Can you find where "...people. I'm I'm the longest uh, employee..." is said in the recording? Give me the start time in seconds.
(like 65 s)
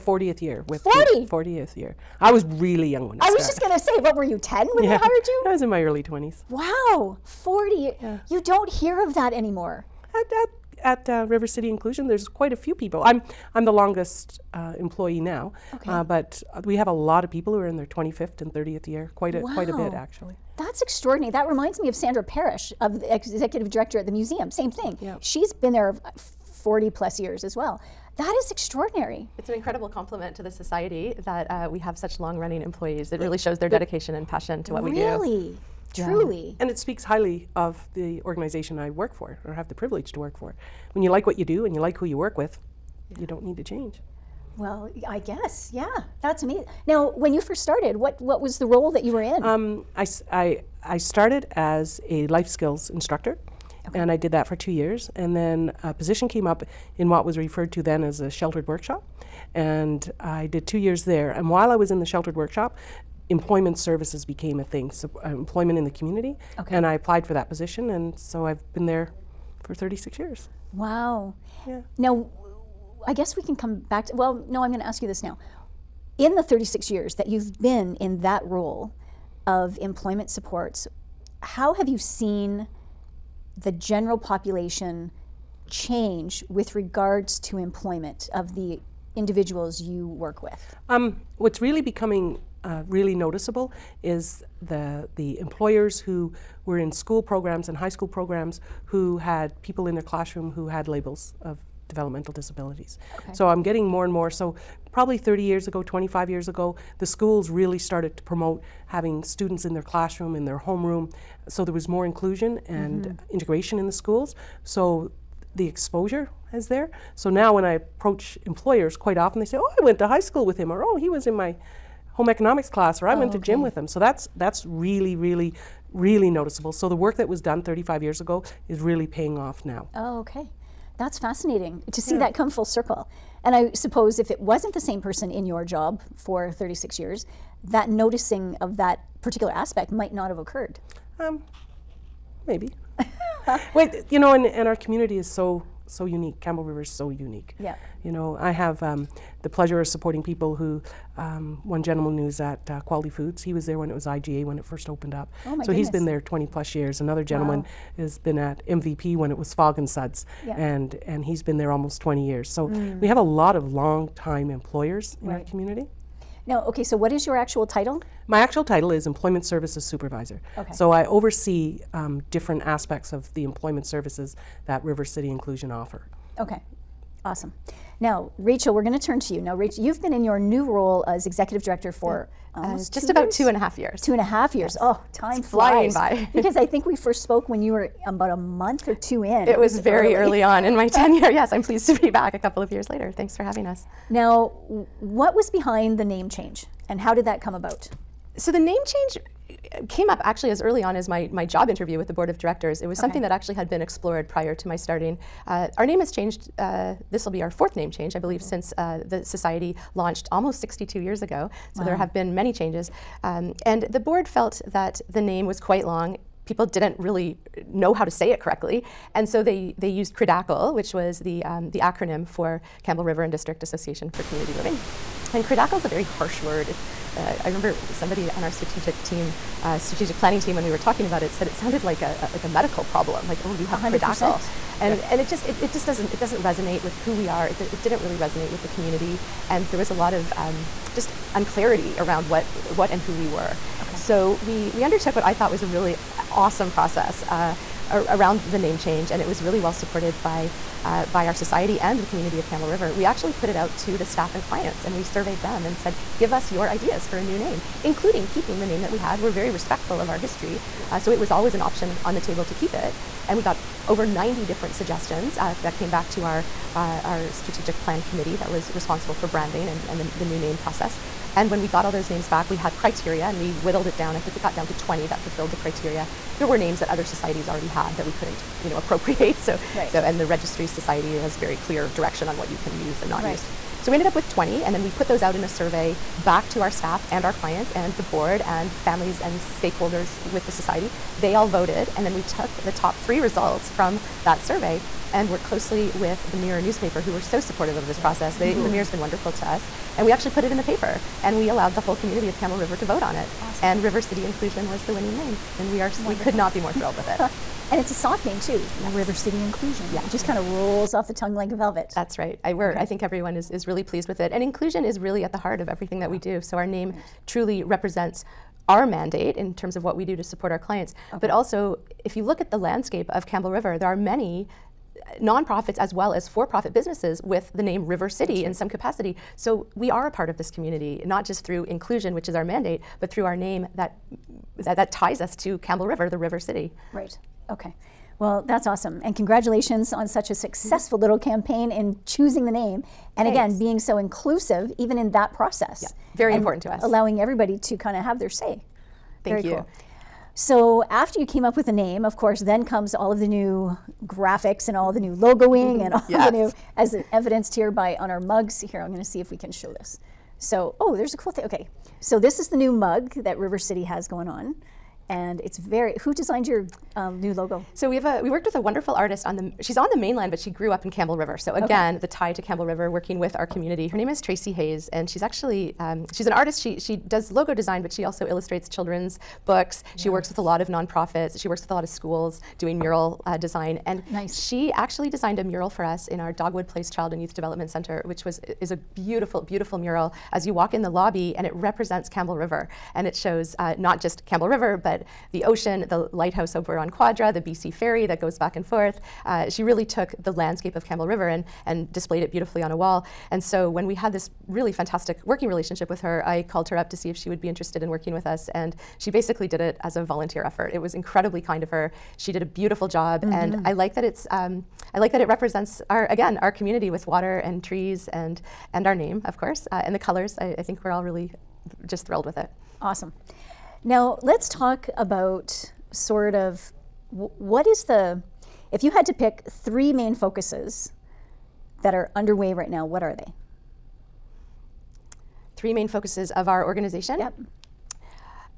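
12 s.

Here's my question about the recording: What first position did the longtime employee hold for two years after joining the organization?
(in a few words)
Life skills instructor.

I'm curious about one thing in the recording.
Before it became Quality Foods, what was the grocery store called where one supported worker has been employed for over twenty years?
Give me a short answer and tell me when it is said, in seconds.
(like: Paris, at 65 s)
IGA, at 154 s.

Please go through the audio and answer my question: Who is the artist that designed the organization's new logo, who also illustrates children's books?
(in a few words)
Tracy Hayes.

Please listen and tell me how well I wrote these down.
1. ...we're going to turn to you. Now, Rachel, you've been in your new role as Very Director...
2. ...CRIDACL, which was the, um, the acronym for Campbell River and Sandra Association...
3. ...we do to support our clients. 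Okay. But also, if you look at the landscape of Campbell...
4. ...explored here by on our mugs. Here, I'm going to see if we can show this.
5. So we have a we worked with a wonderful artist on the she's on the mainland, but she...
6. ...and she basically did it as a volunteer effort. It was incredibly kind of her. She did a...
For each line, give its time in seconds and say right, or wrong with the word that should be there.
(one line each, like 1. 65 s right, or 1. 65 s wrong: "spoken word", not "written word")
1. 178 s wrong: "Executive", not "Very"
2. 220 s wrong: "District", not "Sandra"
3. 319 s right
4. 357 s wrong: "evidenced", not "explored"
5. 367 s right
6. 408 s right.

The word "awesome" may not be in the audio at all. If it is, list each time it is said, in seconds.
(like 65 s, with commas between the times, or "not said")
177 s, 246 s, 303 s, 338 s, 422 s.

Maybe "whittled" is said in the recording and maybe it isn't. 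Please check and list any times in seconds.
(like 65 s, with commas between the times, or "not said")
273 s.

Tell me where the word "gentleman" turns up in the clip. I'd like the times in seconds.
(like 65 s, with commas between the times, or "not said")
151 s, 157 s.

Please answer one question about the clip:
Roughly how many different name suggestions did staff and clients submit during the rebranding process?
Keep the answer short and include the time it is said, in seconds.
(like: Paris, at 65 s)
Over 90, at 263 s.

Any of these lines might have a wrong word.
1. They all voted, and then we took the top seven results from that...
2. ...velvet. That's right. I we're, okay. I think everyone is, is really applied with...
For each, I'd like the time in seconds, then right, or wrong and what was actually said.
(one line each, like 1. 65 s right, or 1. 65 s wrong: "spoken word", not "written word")
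1. 291 s wrong: "three", not "seven"
2. 311 s wrong: "pleased", not "applied".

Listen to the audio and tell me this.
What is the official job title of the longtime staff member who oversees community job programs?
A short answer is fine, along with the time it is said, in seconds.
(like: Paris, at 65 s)
Employment Services Supervisor, at 169 s.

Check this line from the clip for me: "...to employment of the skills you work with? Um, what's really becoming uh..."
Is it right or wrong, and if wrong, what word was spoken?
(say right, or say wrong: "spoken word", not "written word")
wrong: "individuals", not "skills".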